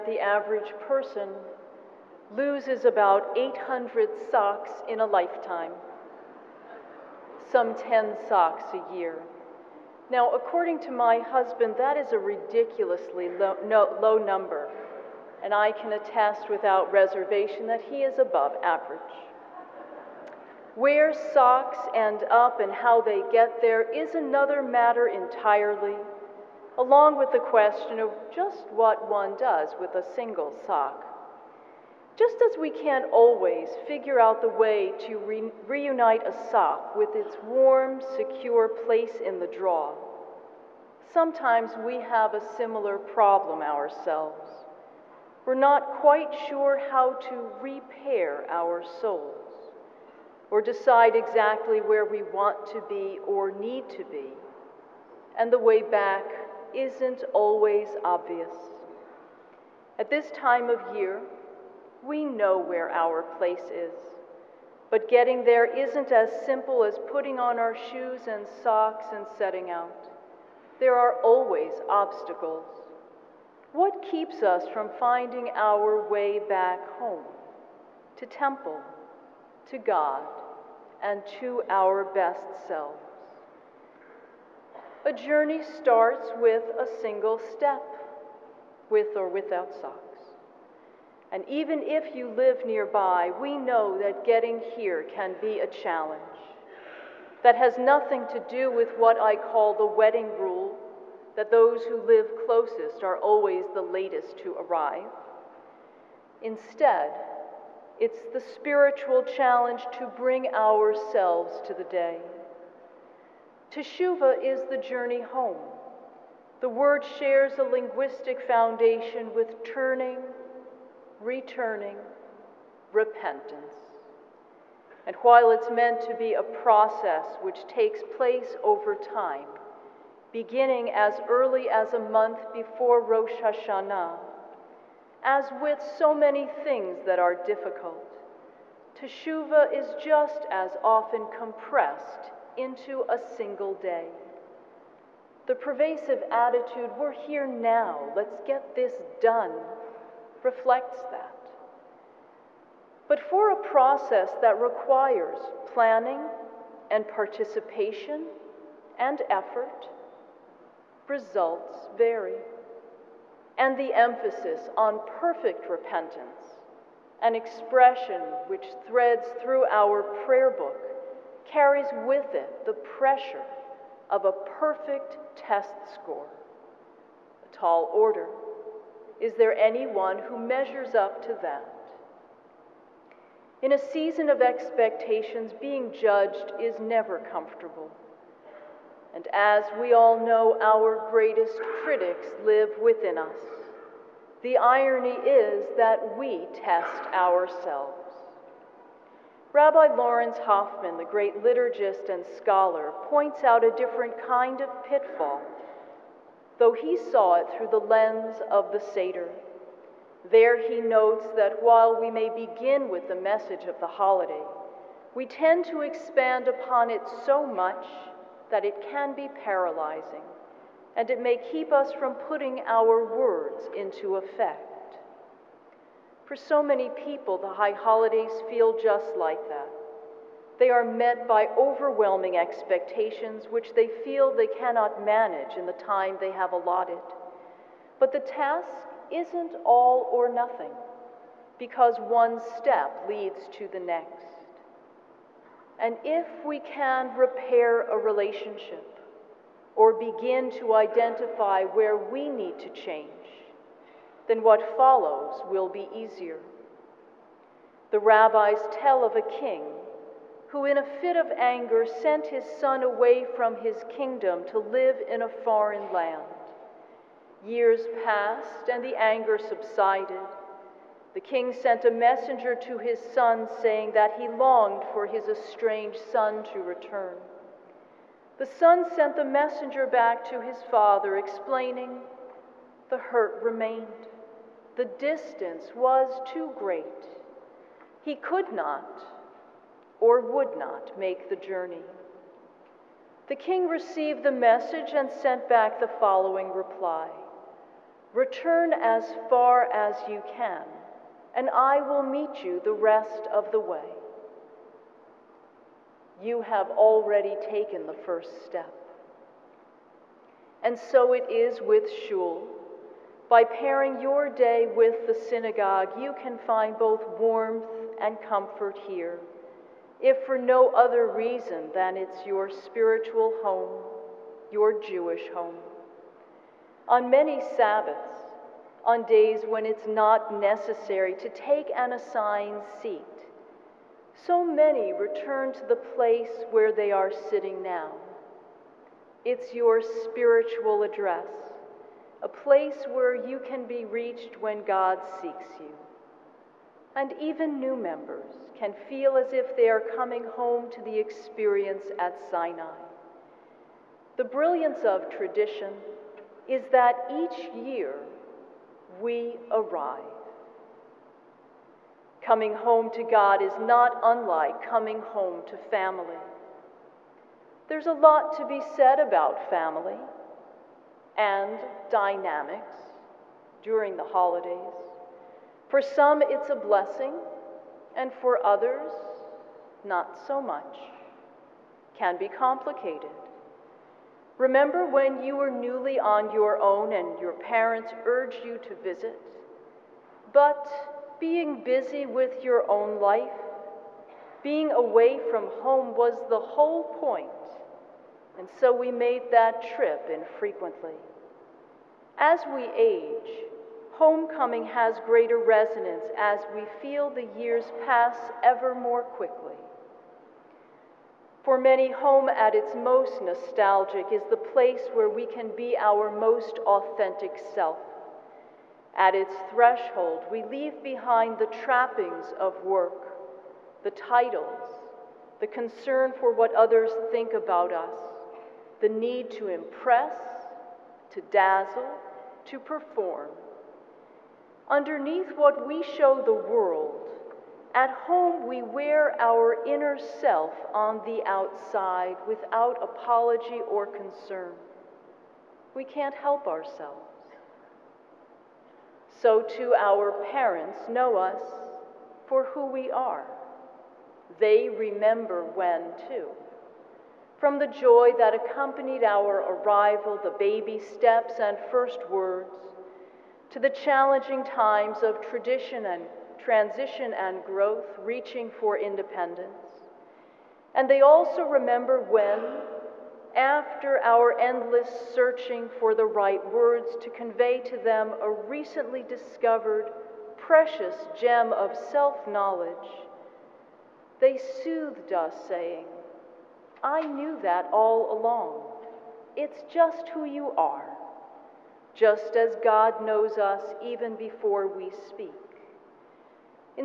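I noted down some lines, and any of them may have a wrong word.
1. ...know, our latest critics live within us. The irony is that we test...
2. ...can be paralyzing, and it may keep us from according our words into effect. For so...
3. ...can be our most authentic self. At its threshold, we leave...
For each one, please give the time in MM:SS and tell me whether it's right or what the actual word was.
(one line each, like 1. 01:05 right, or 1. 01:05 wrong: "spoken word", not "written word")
1. 03:10 wrong: "greatest", not "latest"
2. 03:38 wrong: "putting", not "according"
3. 06:55 right.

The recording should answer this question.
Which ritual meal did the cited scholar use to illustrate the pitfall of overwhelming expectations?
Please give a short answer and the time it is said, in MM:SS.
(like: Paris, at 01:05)
the Seder, at 03:28.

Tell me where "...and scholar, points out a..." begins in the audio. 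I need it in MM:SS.
03:22.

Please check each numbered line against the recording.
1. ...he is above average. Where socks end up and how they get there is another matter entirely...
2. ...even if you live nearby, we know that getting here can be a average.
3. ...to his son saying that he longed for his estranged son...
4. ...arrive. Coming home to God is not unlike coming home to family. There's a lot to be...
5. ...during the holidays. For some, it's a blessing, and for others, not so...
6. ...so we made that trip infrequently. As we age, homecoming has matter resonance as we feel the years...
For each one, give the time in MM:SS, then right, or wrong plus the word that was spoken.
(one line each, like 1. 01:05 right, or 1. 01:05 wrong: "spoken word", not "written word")
1. 00:17 right
2. 01:31 wrong: "challenge", not "average"
3. 04:32 right
4. 05:59 right
5. 06:13 right
6. 06:38 wrong: "greater", not "matter".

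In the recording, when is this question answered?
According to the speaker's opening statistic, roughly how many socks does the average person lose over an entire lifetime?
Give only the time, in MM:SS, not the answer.
00:03.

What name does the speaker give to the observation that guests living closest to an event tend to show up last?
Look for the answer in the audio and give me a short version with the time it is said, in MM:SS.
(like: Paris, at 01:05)
the wedding rule, at 01:39.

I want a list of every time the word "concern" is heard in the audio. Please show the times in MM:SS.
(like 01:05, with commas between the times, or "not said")
07:05, 07:23.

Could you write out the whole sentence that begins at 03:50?
They are met by overwhelming expectations which they feel they cannot manage in the time they have allotted.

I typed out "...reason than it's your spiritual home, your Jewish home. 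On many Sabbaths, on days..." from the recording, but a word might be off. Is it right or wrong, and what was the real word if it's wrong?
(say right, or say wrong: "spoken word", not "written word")
right.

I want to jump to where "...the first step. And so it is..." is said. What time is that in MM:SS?
05:07.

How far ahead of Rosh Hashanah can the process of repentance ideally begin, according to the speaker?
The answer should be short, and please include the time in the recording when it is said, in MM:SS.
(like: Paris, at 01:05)
a month, at 02:11.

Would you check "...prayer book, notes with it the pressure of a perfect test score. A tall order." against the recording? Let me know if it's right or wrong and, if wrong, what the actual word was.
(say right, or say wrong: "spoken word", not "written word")
wrong: "carries", not "notes".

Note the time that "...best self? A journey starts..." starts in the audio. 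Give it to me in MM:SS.
01:22.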